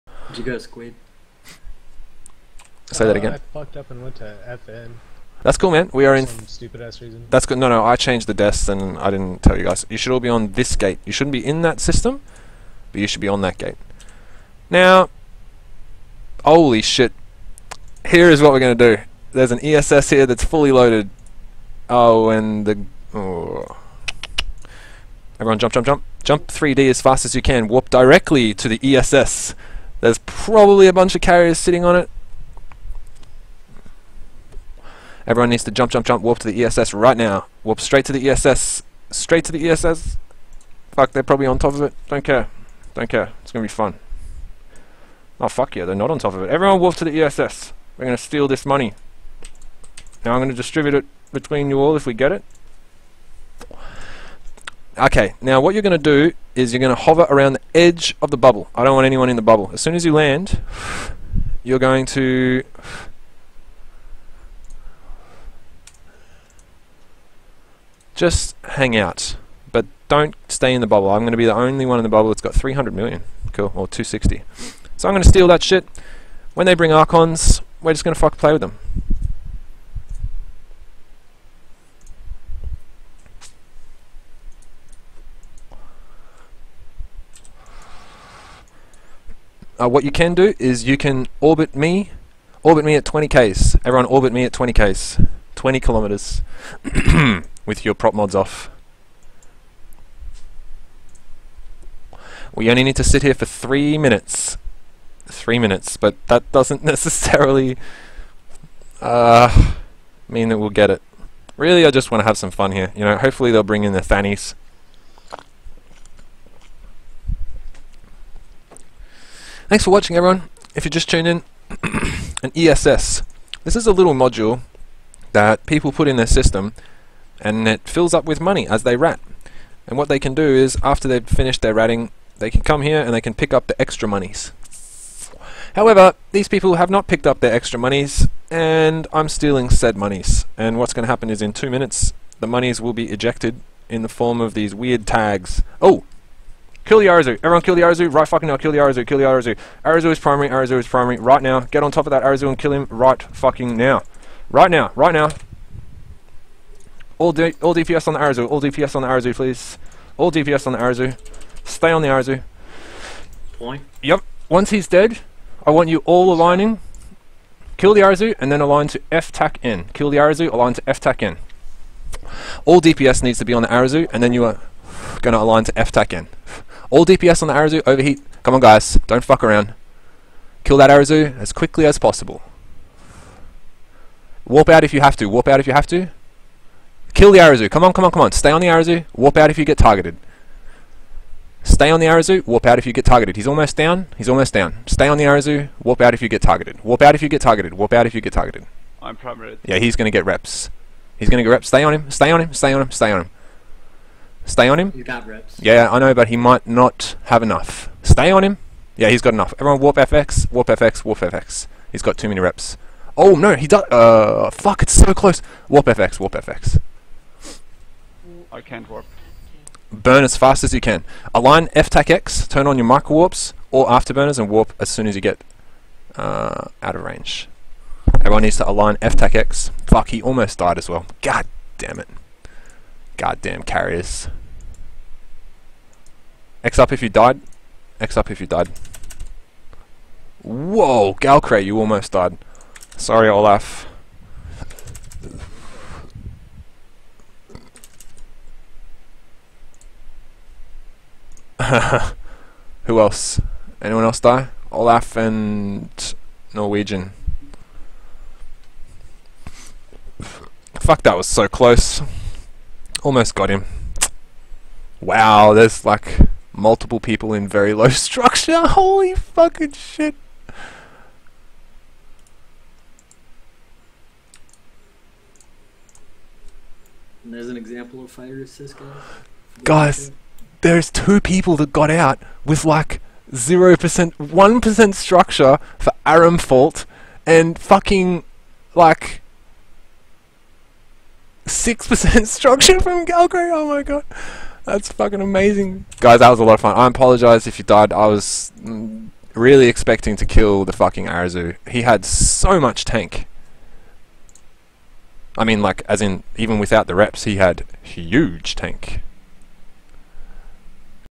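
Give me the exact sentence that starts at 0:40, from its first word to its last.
Fuck, they're probably on top of it.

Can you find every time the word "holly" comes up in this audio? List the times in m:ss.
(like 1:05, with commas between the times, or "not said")
not said.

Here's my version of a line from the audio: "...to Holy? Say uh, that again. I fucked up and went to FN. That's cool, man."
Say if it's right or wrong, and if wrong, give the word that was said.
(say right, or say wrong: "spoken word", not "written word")
wrong: "Squid", not "Holy".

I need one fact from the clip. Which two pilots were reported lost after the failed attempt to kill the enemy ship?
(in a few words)
Olaf and Norwegian.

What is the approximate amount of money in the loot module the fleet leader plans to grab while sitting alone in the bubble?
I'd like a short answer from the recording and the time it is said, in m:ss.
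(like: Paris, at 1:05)
300 million, at 1:12.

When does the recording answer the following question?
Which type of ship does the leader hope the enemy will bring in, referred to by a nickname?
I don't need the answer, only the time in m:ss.
1:54.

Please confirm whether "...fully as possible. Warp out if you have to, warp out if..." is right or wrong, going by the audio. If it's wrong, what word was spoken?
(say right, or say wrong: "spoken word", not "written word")
wrong: "quickly", not "fully".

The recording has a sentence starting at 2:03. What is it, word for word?
This is a little module that people put in their system and it fills up with money as they rat.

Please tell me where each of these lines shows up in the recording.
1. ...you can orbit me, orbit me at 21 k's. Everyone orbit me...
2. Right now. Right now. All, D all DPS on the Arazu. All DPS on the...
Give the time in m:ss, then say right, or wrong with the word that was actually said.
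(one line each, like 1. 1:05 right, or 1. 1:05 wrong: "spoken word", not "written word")
1. 1:30 wrong: "20", not "21"
2. 2:34 right.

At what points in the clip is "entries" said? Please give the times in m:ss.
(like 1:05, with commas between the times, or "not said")
not said.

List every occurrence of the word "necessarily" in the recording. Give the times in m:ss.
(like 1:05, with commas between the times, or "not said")
1:46.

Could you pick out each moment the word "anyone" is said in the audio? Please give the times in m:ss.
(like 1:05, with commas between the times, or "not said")
0:59, 4:13.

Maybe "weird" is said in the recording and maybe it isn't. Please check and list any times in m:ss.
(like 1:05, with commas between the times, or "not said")
2:24.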